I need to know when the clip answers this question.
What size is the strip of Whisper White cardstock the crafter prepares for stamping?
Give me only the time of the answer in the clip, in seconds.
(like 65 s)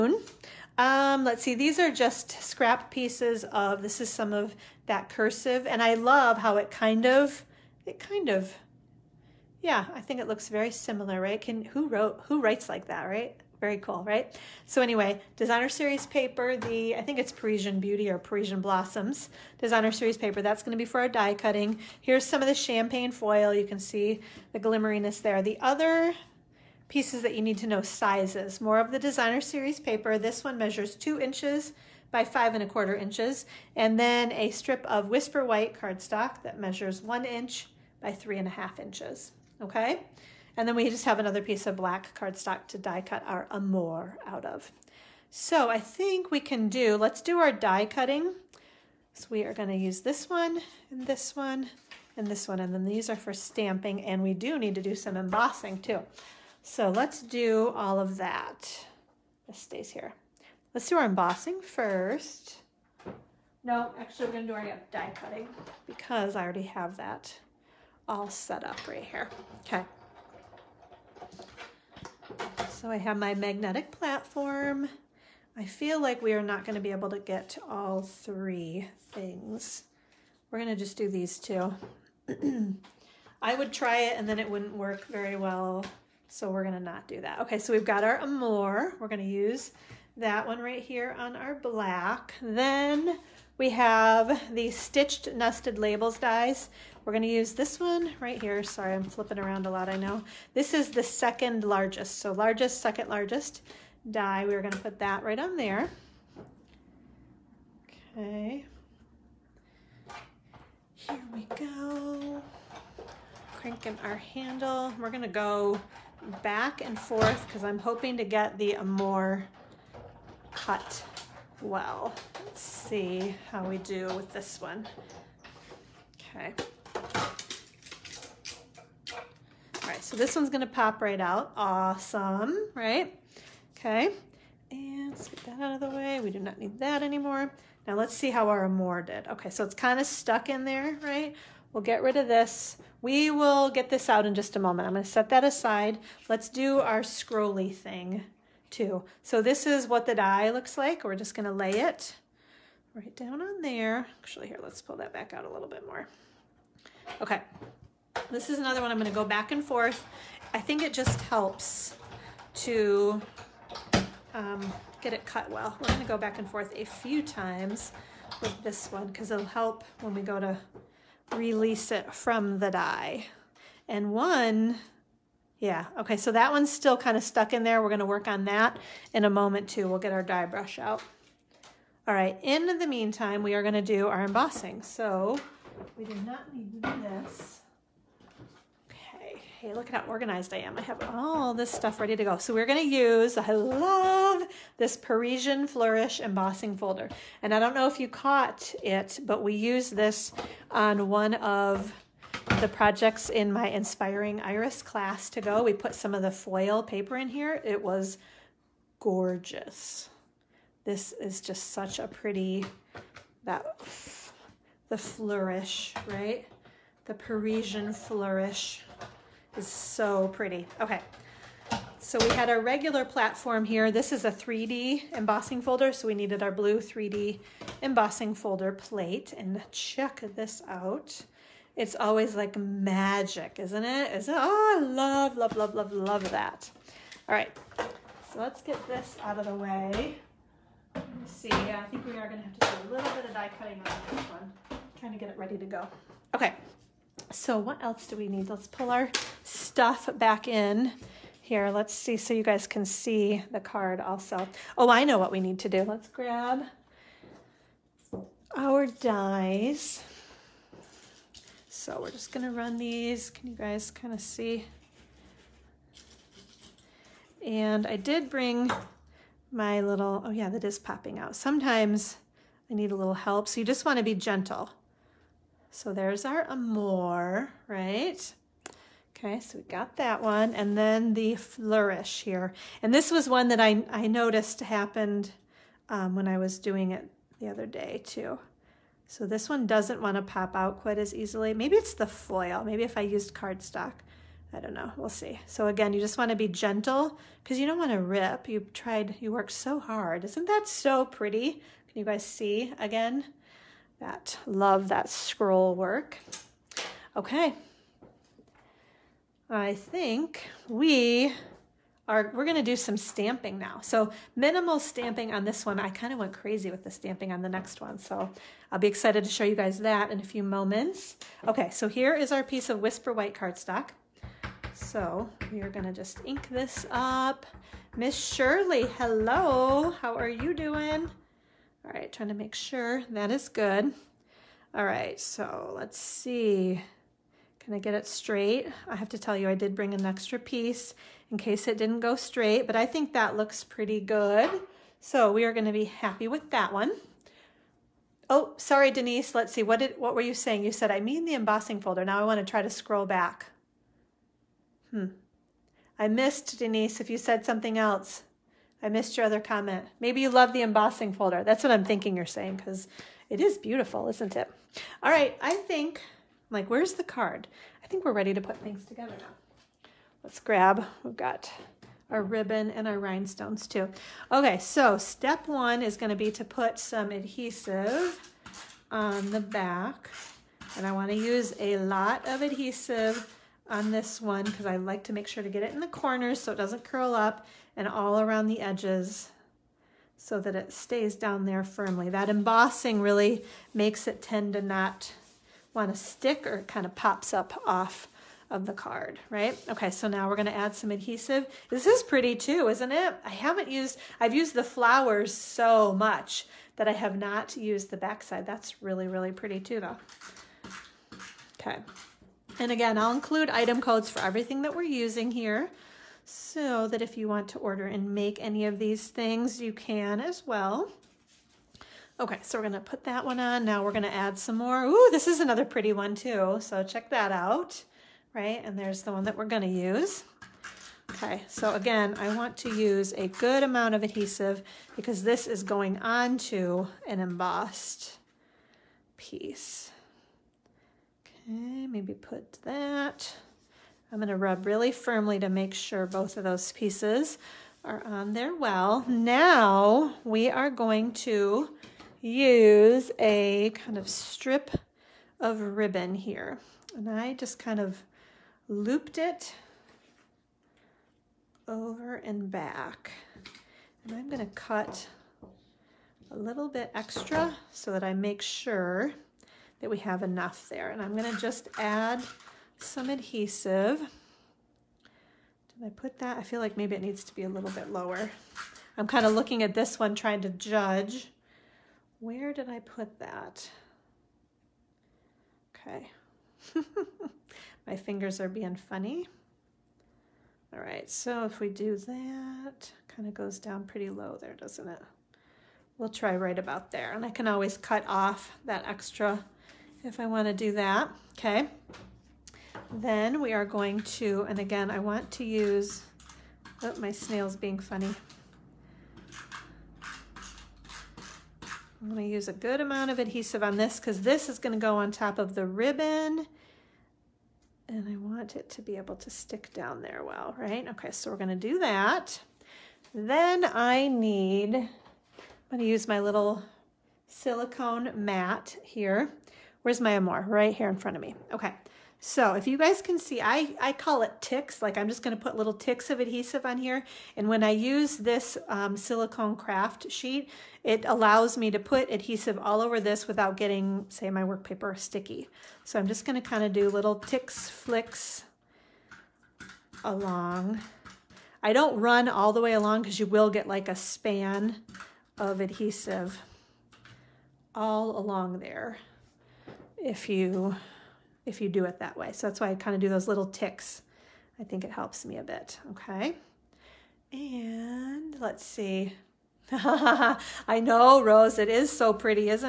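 37 s.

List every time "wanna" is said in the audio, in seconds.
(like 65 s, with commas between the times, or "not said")
273 s, 380 s.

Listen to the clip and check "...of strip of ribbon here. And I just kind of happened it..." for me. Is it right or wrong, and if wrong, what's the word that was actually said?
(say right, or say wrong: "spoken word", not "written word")
wrong: "looped", not "happened".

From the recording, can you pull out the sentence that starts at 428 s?
And there's the one that we're gonna use.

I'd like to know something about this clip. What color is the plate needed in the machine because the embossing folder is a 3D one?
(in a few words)
Blue.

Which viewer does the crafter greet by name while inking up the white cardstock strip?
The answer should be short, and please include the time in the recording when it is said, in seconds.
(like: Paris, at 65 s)
Shirley, at 327 s.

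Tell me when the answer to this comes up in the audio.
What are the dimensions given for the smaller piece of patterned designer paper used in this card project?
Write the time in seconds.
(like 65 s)
30 s.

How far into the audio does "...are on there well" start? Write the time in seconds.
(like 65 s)
447 s.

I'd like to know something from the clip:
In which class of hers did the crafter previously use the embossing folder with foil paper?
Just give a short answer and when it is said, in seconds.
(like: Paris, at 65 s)
Inspiring Iris, at 203 s.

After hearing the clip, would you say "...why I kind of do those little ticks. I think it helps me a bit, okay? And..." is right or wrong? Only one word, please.
right.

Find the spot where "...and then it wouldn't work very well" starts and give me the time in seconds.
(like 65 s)
84 s.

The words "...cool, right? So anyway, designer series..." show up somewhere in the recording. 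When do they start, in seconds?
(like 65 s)
13 s.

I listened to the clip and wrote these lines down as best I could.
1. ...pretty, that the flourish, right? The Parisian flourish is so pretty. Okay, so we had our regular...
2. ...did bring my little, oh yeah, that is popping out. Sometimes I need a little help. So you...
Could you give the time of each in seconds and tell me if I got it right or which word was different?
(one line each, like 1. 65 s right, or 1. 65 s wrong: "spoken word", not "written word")
1. 212 s right
2. 267 s right.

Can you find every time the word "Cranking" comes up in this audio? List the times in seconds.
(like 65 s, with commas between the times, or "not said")
113 s.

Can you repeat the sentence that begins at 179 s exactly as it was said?
We'll get our die brush out.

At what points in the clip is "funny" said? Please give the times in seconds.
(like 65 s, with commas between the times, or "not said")
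488 s, 507 s.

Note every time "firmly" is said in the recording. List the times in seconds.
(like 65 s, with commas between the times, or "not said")
391 s, 444 s.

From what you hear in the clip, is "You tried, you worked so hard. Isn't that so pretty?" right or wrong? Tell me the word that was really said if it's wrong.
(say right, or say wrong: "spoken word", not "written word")
right.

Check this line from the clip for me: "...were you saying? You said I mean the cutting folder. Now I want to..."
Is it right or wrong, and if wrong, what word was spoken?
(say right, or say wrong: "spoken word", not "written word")
wrong: "embossing", not "cutting".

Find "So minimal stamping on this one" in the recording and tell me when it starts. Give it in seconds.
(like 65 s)
313 s.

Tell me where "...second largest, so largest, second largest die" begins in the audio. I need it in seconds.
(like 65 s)
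101 s.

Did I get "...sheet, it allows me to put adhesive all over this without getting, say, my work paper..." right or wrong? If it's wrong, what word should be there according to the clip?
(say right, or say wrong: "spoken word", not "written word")
right.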